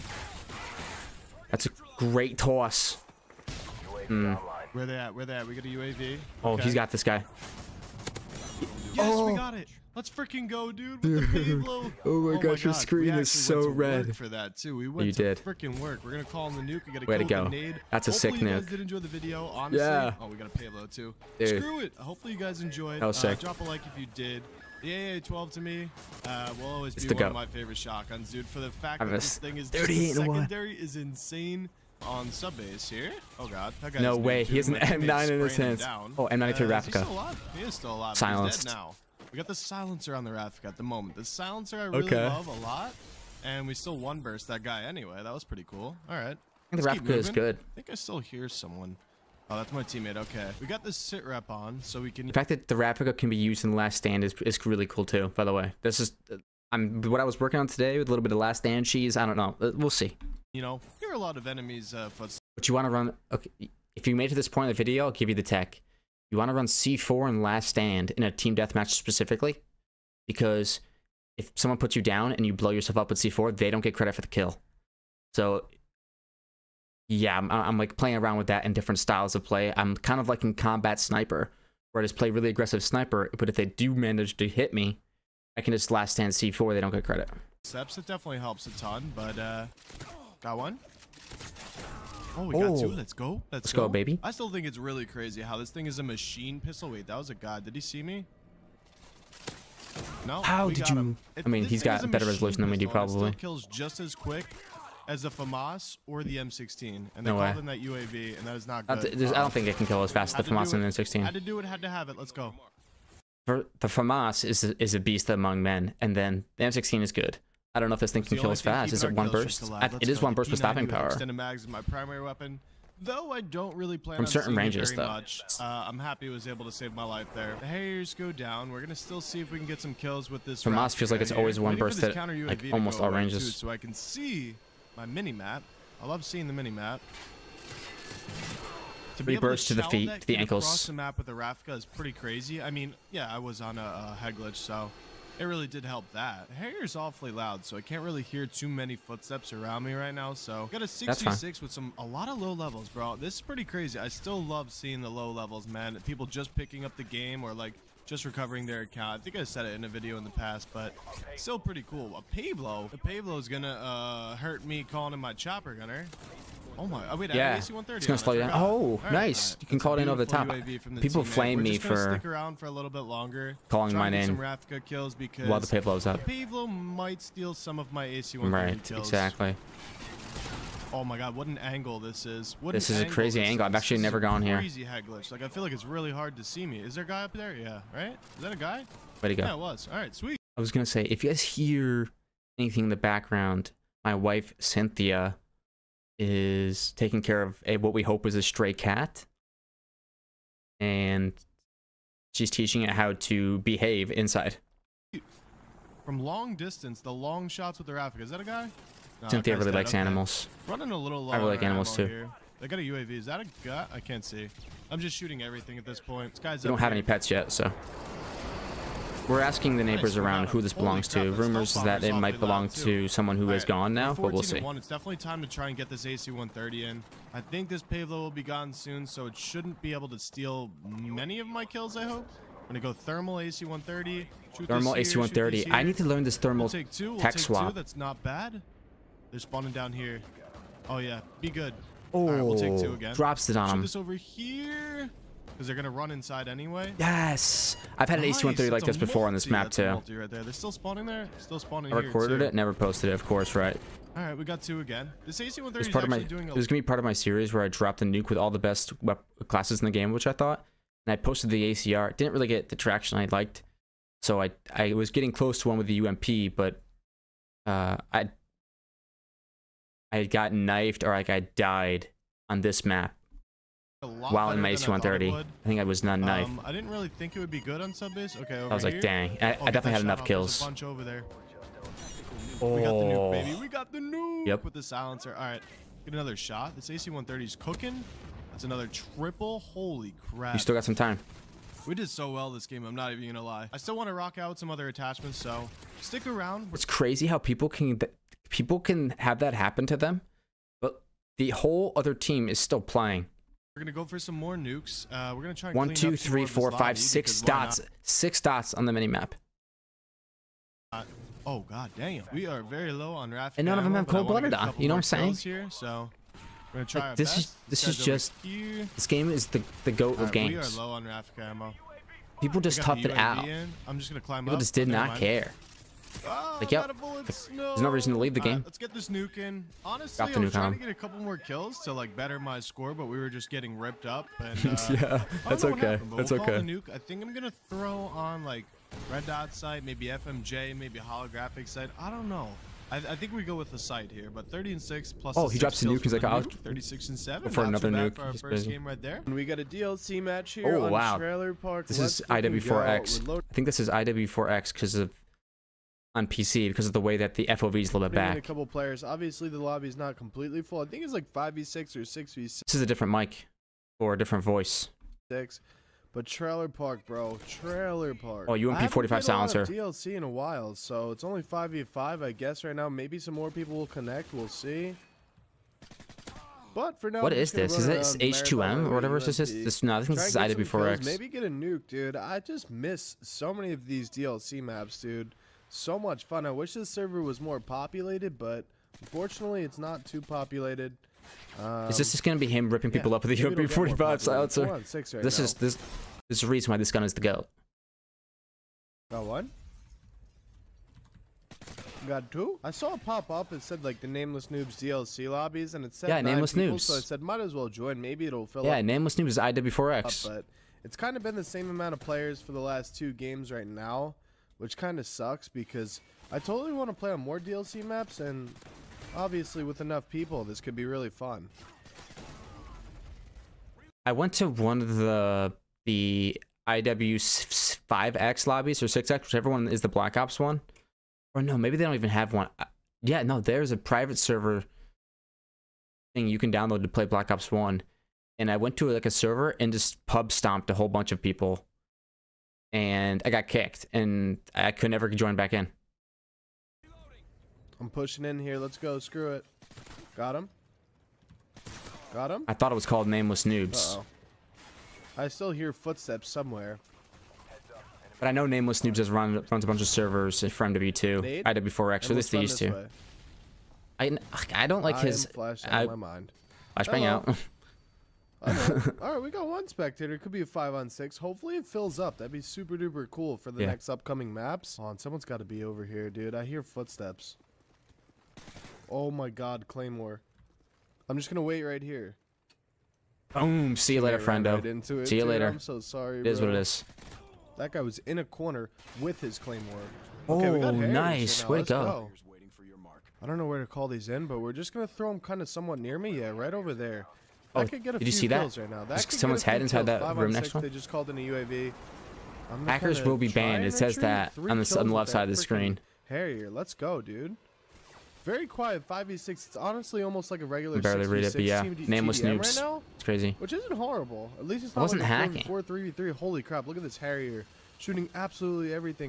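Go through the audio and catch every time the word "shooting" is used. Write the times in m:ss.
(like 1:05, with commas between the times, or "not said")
3:35, 8:37.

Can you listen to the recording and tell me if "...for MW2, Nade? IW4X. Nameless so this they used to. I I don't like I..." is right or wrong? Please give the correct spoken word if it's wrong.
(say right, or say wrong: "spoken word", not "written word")
right.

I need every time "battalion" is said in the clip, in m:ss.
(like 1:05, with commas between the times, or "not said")
not said.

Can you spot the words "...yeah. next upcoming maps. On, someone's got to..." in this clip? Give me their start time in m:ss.
7:53.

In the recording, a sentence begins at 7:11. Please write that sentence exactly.
Or no, maybe they don't even have one.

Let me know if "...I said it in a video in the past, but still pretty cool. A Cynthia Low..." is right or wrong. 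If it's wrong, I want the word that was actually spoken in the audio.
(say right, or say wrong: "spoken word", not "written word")
wrong: "Pave", not "Cynthia".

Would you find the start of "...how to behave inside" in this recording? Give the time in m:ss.
3:22.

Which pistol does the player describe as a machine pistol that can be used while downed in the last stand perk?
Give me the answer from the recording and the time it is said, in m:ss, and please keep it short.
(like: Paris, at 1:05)
M92 Raffica, at 0:36.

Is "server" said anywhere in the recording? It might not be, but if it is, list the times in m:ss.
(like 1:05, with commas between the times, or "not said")
6:26, 7:14, 7:19, 7:39.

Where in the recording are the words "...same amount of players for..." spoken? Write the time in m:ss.
6:51.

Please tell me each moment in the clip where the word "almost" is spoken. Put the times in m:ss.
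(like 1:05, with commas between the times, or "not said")
2:12, 8:30.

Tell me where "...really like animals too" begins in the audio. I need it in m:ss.
3:31.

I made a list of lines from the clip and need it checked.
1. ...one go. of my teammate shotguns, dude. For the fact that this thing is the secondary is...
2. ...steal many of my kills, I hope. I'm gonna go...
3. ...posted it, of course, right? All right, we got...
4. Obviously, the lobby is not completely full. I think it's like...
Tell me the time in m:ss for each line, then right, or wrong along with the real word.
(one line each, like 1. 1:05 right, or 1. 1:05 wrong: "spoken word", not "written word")
1. 0:27 wrong: "favorite", not "teammate"
2. 3:50 right
3. 4:12 right
4. 5:59 right.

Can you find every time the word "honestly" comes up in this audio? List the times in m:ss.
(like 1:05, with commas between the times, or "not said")
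0:19, 5:29, 8:29.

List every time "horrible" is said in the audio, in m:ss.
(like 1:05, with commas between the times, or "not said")
8:33.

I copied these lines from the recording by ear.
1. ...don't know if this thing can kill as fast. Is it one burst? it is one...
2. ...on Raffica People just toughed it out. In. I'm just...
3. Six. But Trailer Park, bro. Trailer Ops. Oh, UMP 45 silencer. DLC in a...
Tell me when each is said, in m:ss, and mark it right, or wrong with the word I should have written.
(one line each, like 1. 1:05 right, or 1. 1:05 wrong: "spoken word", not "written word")
1. 1:57 right
2. 5:20 right
3. 6:05 wrong: "Park", not "Ops".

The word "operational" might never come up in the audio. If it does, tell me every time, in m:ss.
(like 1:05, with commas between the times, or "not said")
not said.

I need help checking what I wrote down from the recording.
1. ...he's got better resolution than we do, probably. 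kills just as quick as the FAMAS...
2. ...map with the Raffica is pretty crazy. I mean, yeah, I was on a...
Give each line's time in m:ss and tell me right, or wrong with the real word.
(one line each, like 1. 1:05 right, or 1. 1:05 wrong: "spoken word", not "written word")
1. 1:41 right
2. 2:20 right.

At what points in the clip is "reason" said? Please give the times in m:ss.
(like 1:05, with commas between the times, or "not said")
5:27, 6:36.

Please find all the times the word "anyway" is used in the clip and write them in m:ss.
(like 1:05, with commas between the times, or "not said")
0:44, 4:06.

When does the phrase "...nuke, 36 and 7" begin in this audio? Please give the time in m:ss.
5:46.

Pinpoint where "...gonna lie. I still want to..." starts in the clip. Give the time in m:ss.
4:53.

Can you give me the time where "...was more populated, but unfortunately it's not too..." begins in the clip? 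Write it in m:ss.
6:27.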